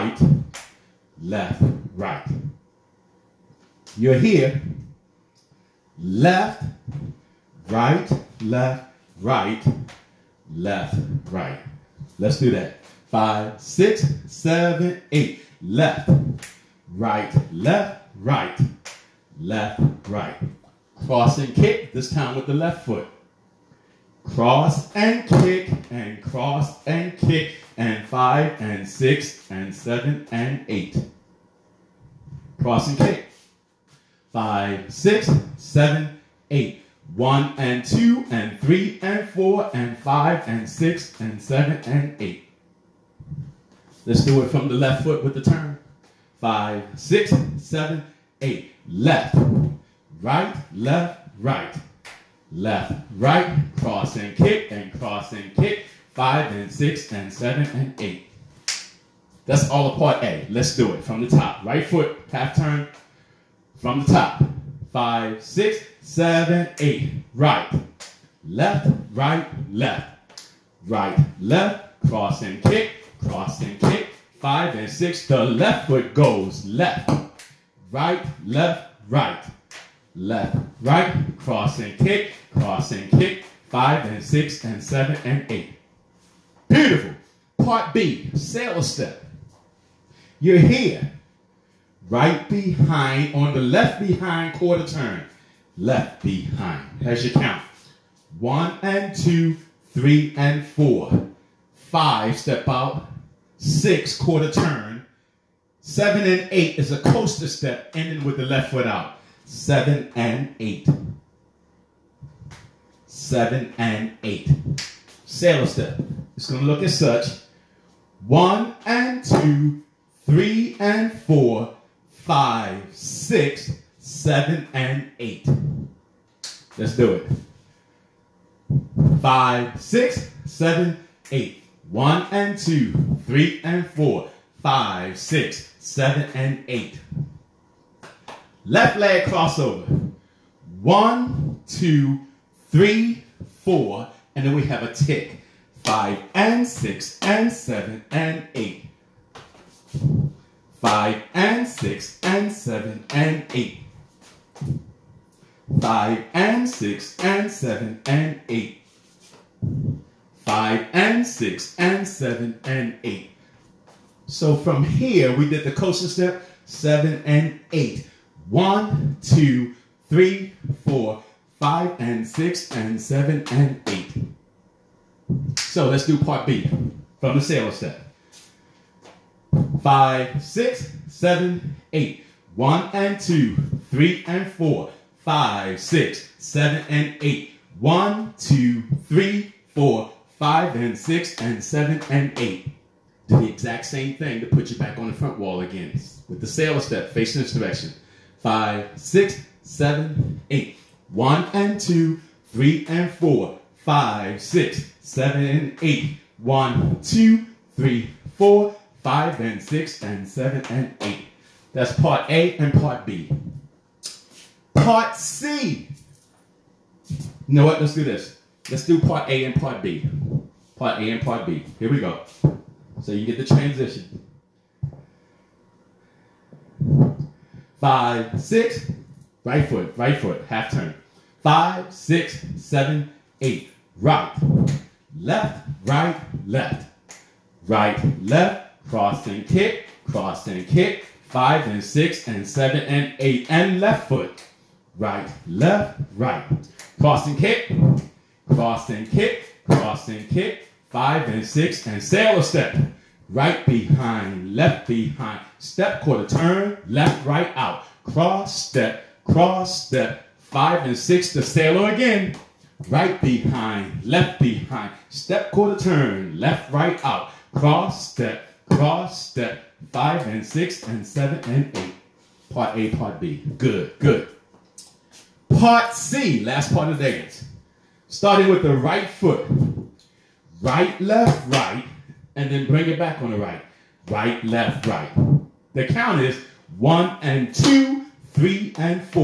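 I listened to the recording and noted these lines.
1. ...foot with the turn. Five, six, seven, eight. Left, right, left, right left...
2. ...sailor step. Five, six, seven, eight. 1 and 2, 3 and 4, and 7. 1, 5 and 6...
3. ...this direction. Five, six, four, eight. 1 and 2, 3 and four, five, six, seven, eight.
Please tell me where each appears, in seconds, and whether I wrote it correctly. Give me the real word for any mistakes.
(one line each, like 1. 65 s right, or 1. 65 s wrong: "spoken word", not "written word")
1. 45 s right
2. 177 s wrong: "8", not "7"
3. 197 s wrong: "seven", not "four".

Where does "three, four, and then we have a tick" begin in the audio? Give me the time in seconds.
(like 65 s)
142 s.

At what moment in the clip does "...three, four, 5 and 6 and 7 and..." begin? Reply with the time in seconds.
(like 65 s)
170 s.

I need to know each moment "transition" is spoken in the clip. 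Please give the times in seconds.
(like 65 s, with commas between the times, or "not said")
223 s.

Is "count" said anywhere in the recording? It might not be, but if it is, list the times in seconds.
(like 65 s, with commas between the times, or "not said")
97 s, 285 s.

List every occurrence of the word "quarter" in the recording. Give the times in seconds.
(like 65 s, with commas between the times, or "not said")
94 s, 104 s, 256 s, 265 s.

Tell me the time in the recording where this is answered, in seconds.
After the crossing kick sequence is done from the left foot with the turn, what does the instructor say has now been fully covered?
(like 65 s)
59 s.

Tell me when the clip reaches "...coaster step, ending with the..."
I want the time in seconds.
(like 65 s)
107 s.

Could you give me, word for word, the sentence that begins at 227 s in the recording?
Five, six, right foot, right foot, half turn five, six, seven, eight.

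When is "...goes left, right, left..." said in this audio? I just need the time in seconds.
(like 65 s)
76 s.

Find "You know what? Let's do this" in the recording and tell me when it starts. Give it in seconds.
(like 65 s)
217 s.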